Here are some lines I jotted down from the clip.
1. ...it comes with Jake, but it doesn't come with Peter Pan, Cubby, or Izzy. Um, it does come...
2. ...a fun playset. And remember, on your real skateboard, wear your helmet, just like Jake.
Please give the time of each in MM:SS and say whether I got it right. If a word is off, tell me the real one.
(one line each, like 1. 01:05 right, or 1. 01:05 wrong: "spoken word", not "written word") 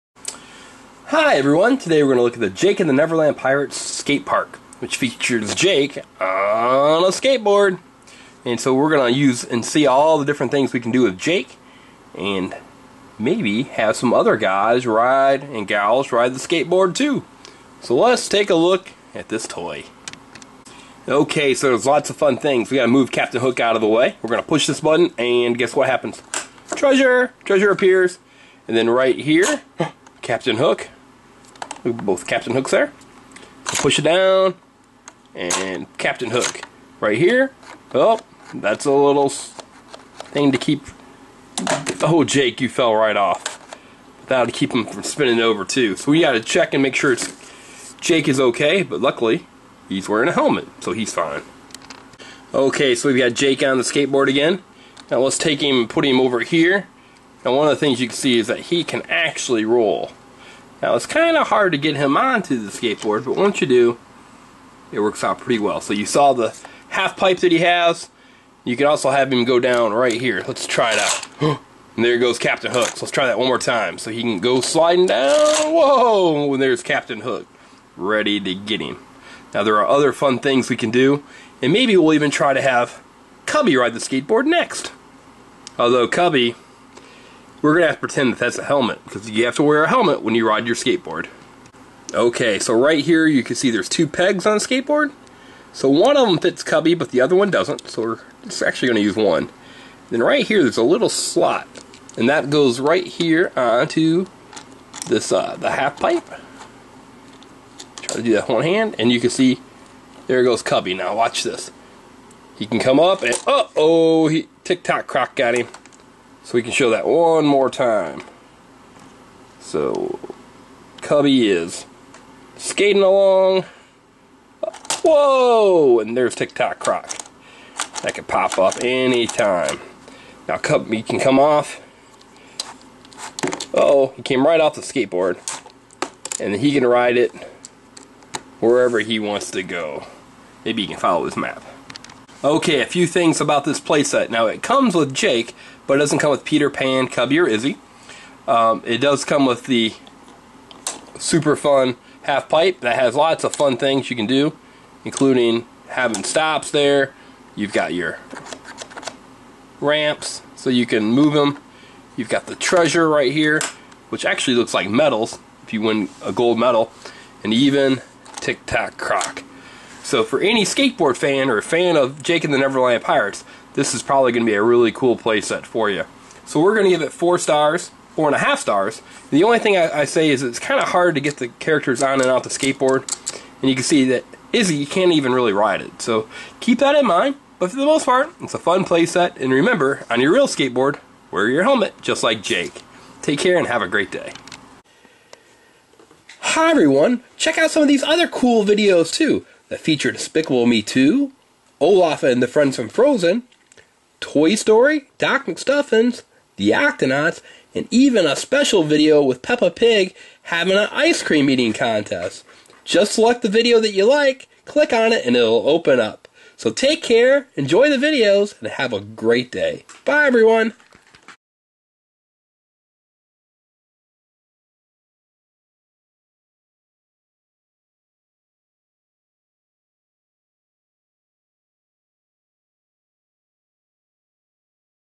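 1. 02:24 right
2. 03:08 right.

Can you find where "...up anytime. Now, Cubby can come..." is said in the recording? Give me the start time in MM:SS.
02:08.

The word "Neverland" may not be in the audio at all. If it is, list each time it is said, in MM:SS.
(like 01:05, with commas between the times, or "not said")
00:02, 02:52.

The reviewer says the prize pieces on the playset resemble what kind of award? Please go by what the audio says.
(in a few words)
Gold medal.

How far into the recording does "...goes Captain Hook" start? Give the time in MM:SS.
01:12.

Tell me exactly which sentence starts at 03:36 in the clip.
So take care, enjoy the videos, and have a great day.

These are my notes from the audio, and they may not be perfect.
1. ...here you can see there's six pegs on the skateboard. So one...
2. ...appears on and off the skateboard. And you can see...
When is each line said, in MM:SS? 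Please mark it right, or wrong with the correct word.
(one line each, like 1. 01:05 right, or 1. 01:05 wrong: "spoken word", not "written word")
1. 01:33 wrong: "two", not "six"
2. 03:01 wrong: "characters", not "appears".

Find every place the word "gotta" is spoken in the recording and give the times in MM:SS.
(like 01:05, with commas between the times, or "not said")
00:22, 00:46.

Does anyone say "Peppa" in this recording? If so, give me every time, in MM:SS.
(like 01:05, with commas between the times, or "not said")
03:29.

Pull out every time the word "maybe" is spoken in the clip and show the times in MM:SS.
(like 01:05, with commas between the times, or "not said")
00:13, 01:21, 02:20.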